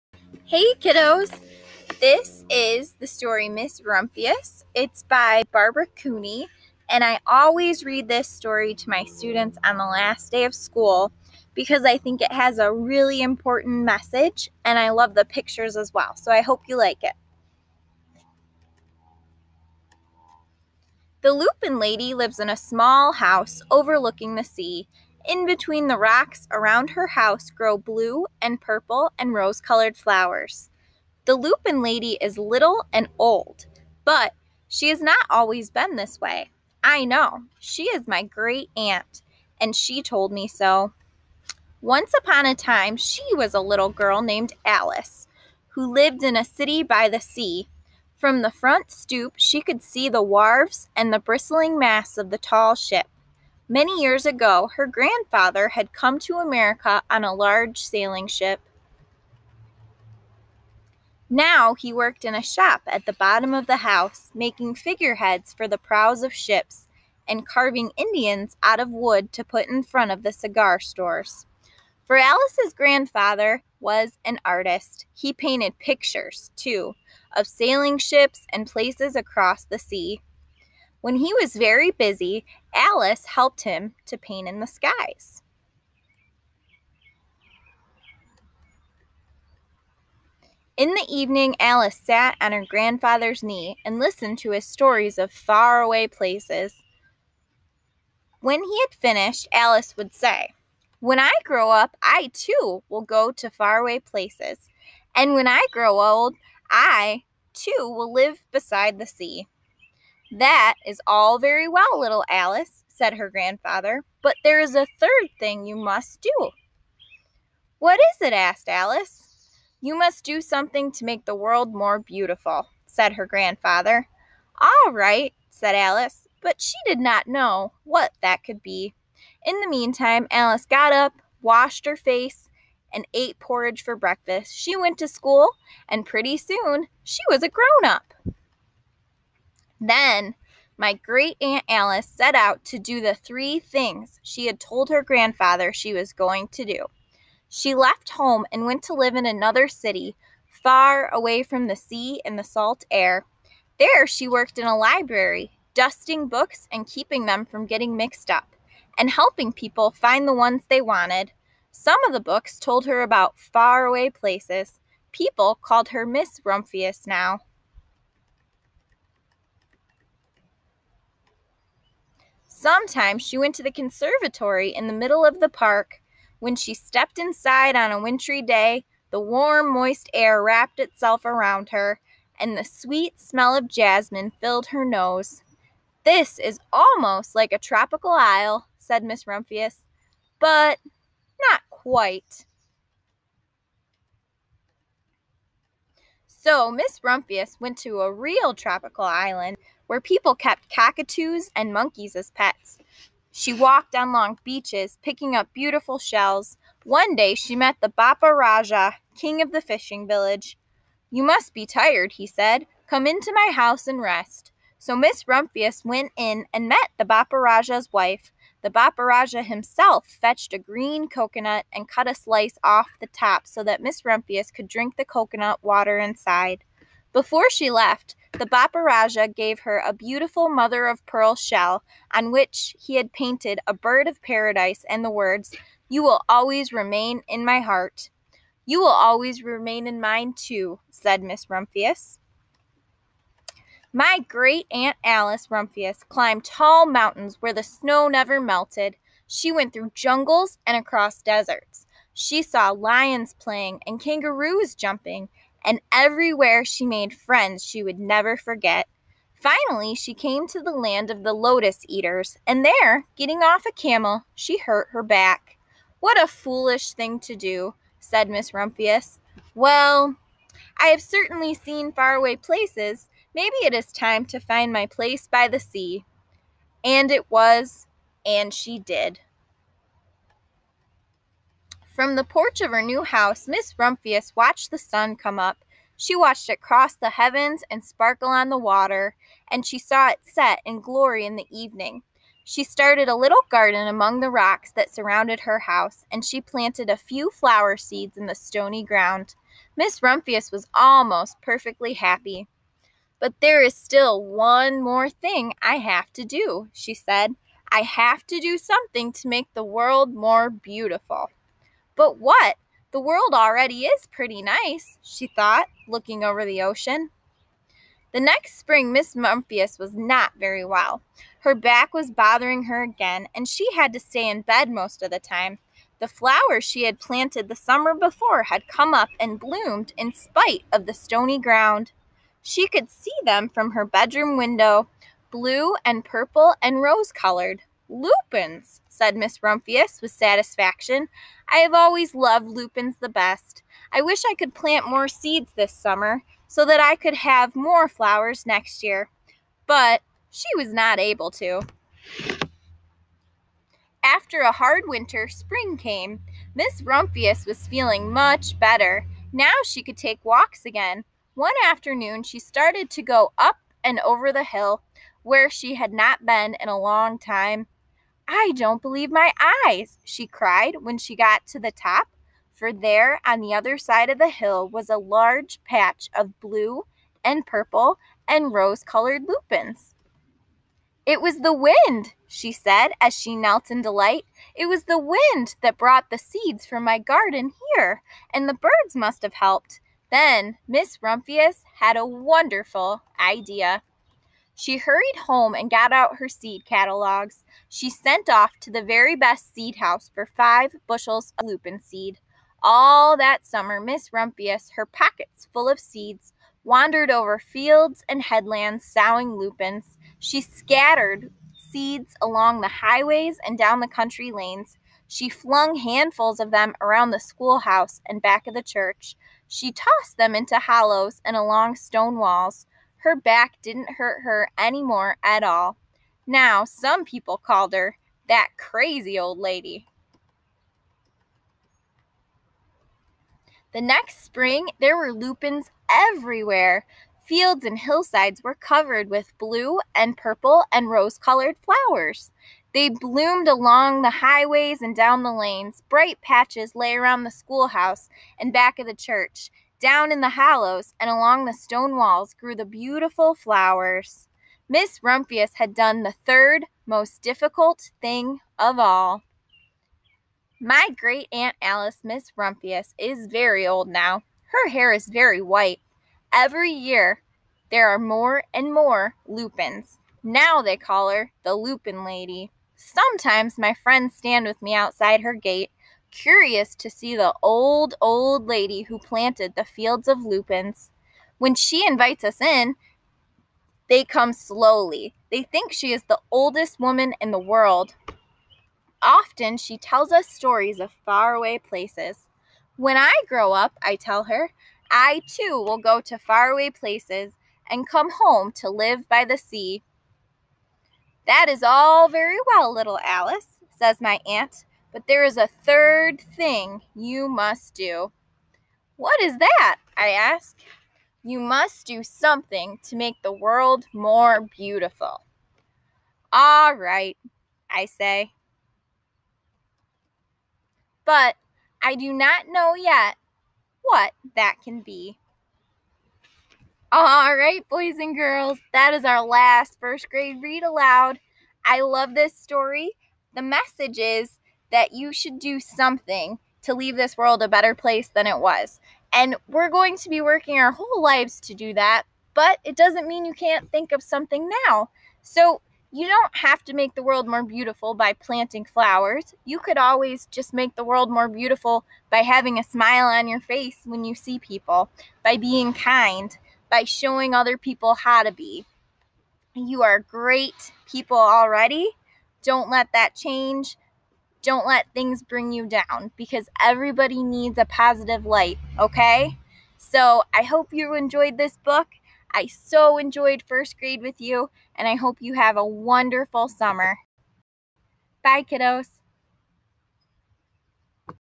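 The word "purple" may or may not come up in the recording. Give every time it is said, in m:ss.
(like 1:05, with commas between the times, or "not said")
0:28, 5:36, 6:17, 7:20.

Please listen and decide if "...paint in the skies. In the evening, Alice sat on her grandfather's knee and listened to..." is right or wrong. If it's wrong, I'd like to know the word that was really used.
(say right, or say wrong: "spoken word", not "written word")
right.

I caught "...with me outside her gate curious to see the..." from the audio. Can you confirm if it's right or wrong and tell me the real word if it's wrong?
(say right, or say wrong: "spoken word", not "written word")
right.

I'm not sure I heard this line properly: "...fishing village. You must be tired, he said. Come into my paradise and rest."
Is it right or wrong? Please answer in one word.
wrong.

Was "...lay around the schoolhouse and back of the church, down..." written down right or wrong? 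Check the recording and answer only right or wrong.
right.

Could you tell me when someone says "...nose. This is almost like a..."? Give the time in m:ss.
3:04.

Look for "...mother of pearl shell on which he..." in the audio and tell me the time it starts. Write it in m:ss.
3:50.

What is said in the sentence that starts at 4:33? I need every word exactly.
Maybe it is time to find my place by the sea.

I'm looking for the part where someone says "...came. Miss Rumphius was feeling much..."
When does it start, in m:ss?
5:55.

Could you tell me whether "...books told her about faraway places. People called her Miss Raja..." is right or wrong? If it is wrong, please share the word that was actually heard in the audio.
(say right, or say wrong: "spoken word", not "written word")
wrong: "Rumphius", not "Raja".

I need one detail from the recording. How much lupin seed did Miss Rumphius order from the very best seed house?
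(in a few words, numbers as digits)
5 bushels.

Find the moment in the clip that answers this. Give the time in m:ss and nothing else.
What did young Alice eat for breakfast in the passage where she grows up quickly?
2:13.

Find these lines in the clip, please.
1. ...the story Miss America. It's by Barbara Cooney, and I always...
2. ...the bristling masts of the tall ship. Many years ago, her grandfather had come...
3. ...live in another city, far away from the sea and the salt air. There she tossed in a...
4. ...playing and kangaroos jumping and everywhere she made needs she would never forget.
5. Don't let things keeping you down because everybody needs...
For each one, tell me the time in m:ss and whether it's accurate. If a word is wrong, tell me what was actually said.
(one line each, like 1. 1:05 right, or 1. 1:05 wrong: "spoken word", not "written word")
1. 0:02 wrong: "Rumphius", not "America"
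2. 0:51 right
3. 2:28 wrong: "worked", not "tossed"
4. 4:13 wrong: "friends", not "needs"
5. 9:24 wrong: "bring", not "keeping".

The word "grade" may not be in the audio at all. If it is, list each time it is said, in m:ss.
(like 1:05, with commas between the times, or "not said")
8:50, 9:33.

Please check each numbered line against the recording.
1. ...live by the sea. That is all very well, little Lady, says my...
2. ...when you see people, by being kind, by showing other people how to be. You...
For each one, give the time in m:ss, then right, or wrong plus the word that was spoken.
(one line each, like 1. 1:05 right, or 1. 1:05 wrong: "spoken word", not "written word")
1. 8:18 wrong: "Alice", not "Lady"
2. 9:13 right.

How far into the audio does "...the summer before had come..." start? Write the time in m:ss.
5:27.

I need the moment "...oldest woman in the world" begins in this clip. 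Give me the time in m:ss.
8:06.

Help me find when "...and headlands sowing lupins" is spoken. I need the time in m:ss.
6:48.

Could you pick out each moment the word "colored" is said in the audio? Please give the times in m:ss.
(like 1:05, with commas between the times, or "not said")
0:29, 5:37, 6:18, 7:21.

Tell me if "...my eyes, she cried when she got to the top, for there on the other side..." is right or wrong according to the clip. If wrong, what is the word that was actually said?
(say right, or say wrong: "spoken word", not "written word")
right.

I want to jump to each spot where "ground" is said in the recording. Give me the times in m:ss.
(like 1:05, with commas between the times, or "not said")
4:58, 5:31.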